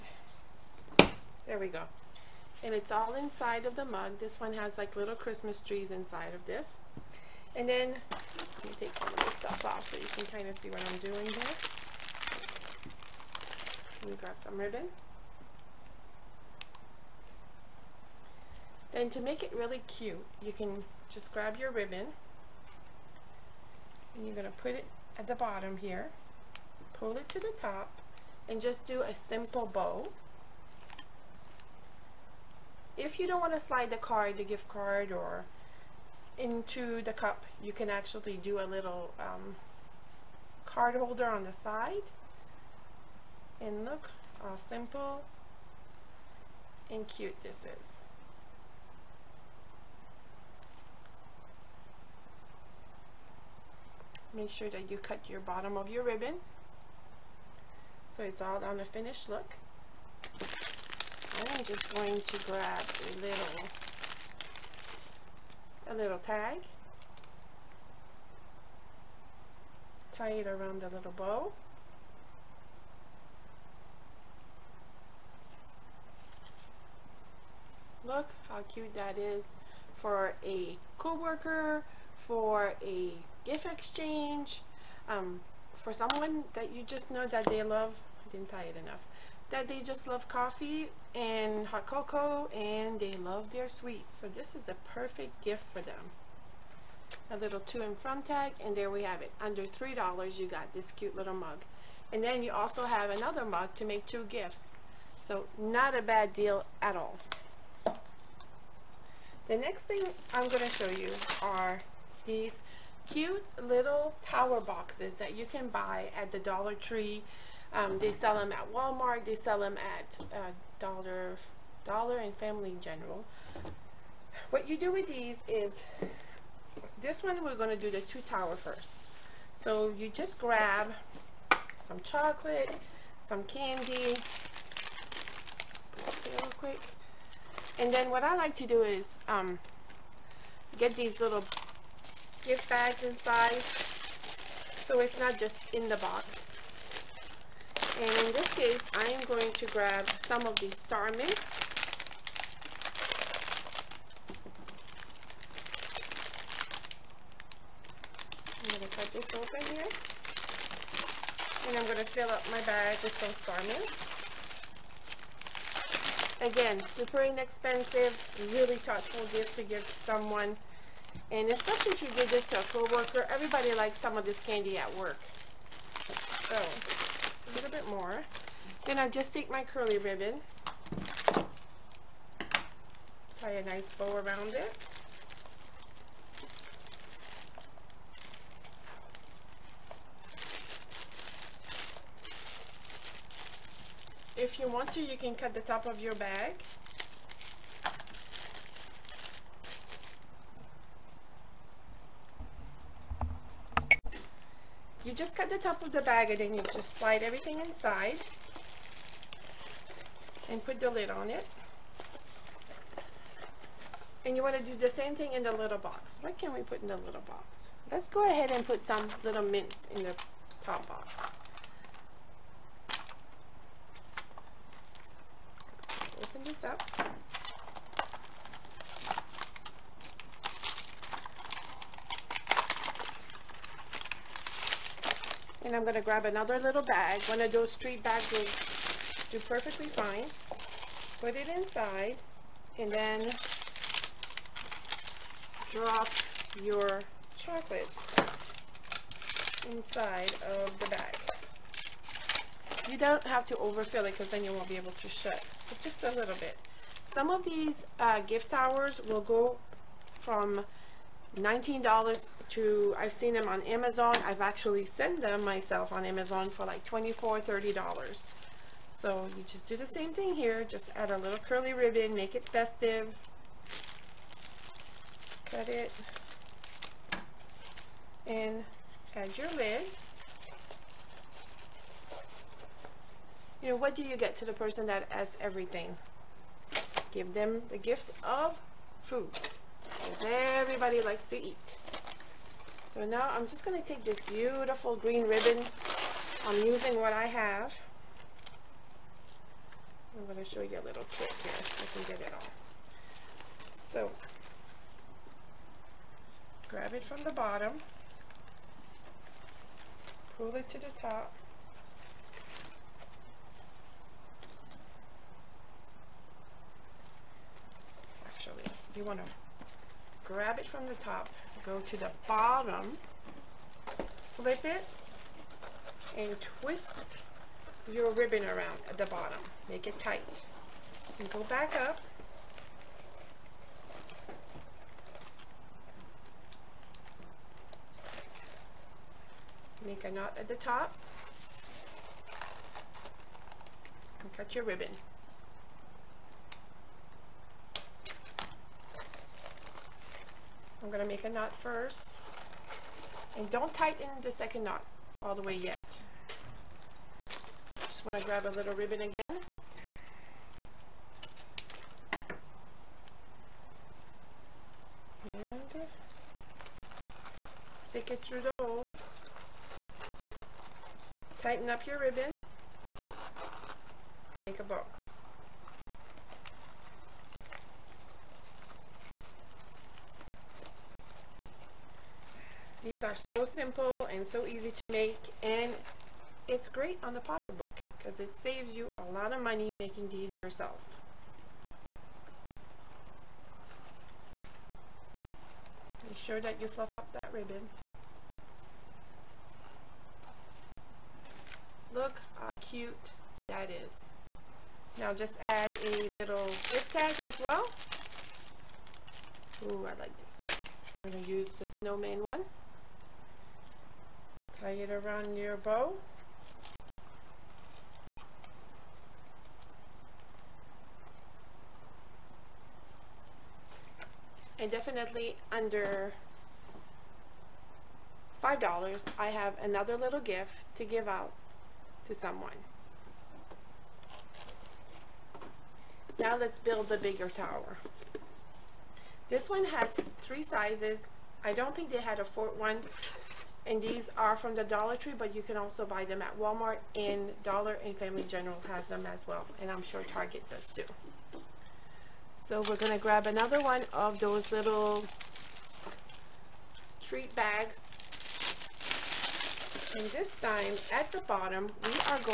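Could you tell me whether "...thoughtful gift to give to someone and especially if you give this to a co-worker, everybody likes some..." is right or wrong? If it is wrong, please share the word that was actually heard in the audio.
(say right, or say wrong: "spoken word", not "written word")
right.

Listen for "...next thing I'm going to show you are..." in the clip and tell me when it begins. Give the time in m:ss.
1:49.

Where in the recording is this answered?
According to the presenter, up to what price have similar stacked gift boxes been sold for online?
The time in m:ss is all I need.
4:27.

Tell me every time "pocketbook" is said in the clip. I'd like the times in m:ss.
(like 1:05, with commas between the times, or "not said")
6:27.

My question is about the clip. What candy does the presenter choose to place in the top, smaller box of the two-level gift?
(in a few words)
mints.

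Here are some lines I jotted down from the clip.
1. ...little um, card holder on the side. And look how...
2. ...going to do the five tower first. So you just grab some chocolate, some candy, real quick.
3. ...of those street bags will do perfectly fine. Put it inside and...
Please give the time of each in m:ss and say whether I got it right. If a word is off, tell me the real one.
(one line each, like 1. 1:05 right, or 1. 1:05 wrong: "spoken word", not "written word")
1. 0:38 right
2. 2:07 wrong: "two", not "five"
3. 3:57 right.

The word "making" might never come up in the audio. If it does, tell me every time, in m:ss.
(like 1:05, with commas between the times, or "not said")
6:29.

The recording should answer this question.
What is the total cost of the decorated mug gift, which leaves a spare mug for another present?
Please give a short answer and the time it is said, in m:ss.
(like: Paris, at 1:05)
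under $3, at 1:39.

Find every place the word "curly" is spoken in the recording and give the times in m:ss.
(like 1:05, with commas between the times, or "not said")
2:59, 4:31.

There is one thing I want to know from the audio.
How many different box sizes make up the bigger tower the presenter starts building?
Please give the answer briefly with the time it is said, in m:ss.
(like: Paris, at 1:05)
3, at 7:20.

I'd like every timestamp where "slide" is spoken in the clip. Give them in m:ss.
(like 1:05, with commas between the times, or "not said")
0:33, 3:26.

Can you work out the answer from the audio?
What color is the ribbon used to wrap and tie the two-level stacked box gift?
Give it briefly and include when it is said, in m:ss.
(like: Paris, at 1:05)
green, at 4:54.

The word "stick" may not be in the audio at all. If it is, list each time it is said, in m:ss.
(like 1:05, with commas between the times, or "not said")
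6:07.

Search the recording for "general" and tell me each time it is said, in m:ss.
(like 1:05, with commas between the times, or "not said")
2:02, 7:28.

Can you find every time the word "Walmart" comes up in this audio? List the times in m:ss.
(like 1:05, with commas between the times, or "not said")
1:58, 7:26.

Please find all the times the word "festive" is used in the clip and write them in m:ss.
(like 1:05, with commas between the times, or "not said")
4:32.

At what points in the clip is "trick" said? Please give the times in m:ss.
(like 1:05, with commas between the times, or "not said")
5:01.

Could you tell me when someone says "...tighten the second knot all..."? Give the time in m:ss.
5:53.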